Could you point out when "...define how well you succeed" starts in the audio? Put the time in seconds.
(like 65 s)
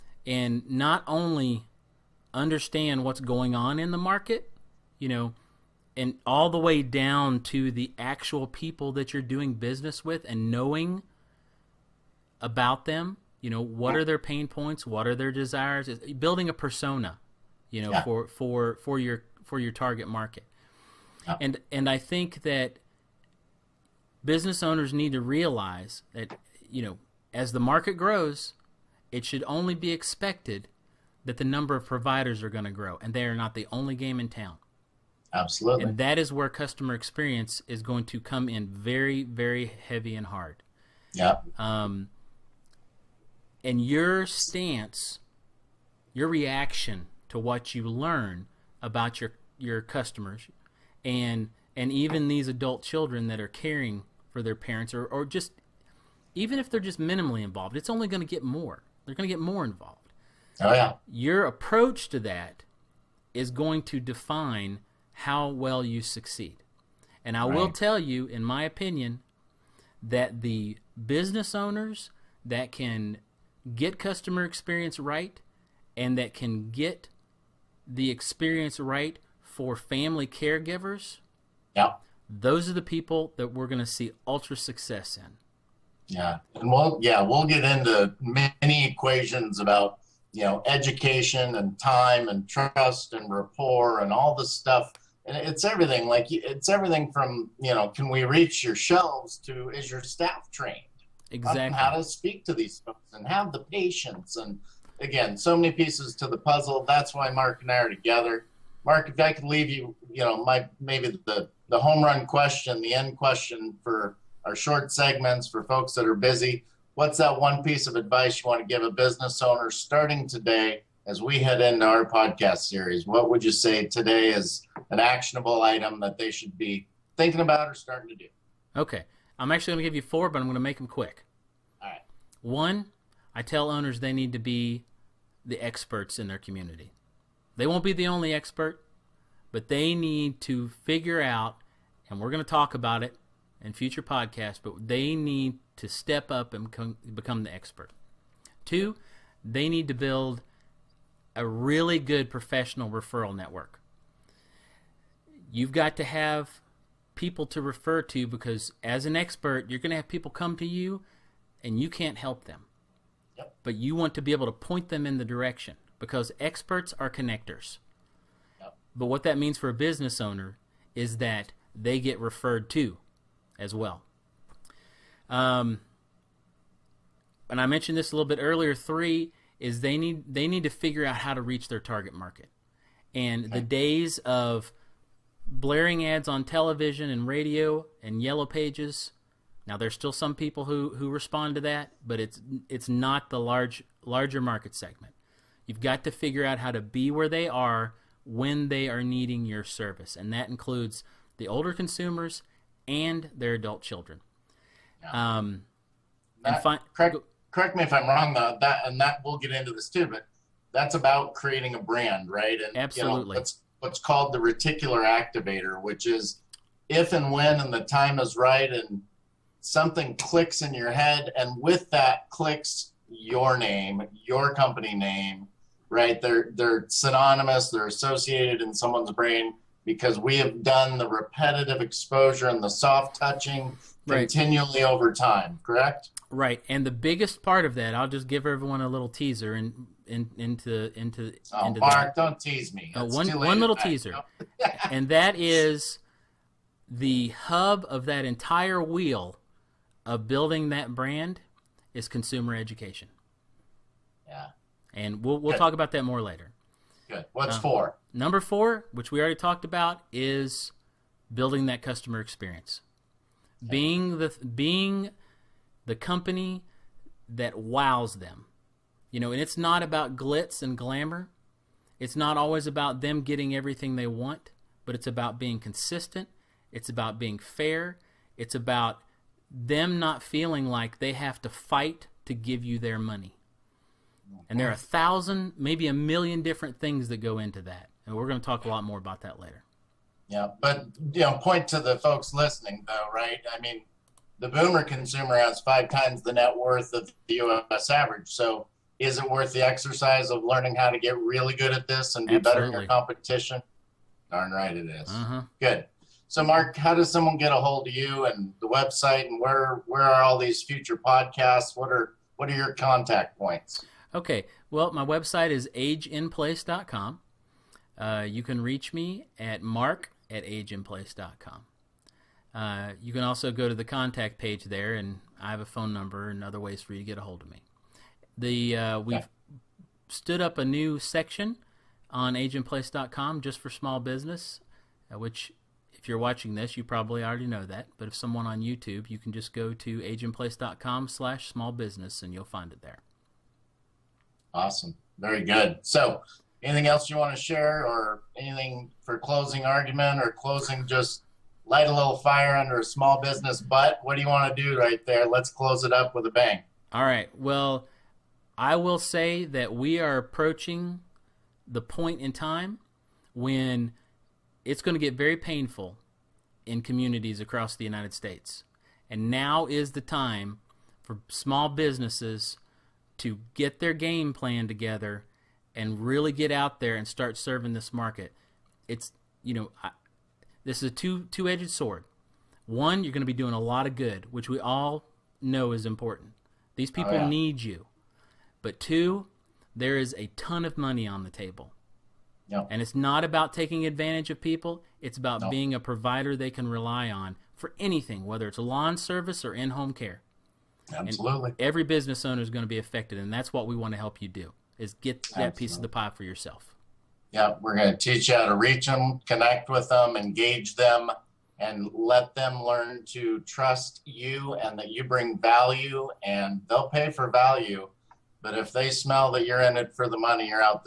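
63 s.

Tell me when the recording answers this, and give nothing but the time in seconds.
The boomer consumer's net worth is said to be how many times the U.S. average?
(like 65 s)
295 s.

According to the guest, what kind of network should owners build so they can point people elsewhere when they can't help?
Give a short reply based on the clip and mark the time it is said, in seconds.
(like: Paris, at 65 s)
Professional referral network, at 152 s.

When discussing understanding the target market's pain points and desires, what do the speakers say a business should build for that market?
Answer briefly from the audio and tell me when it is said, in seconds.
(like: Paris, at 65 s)
A persona, at 16 s.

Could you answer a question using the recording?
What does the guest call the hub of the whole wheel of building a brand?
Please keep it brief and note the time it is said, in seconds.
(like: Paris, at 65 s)
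Consumer education, at 252 s.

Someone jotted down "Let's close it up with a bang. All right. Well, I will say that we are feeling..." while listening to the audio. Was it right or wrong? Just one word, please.
wrong.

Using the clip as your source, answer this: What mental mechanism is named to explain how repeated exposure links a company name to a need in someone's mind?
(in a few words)
Reticular activator.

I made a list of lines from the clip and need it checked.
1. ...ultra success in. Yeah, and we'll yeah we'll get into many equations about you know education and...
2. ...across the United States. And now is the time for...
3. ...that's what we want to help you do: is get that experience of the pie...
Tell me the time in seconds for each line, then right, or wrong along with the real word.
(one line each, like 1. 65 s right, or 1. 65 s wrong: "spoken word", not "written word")
1. 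84 s right
2. 367 s right
3. 403 s wrong: "piece", not "experience".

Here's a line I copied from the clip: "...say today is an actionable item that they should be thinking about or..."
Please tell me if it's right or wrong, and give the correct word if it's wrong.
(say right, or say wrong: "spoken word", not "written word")
right.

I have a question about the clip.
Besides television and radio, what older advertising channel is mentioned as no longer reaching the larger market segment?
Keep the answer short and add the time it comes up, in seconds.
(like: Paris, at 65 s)
Yellow pages, at 188 s.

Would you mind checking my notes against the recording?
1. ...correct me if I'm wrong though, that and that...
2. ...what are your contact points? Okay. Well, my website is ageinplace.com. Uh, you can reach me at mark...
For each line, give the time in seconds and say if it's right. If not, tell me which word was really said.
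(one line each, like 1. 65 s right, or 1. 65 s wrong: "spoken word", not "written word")
1. 207 s right
2. 312 s right.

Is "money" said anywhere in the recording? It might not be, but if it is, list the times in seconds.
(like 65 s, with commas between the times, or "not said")
282 s, 390 s, 420 s.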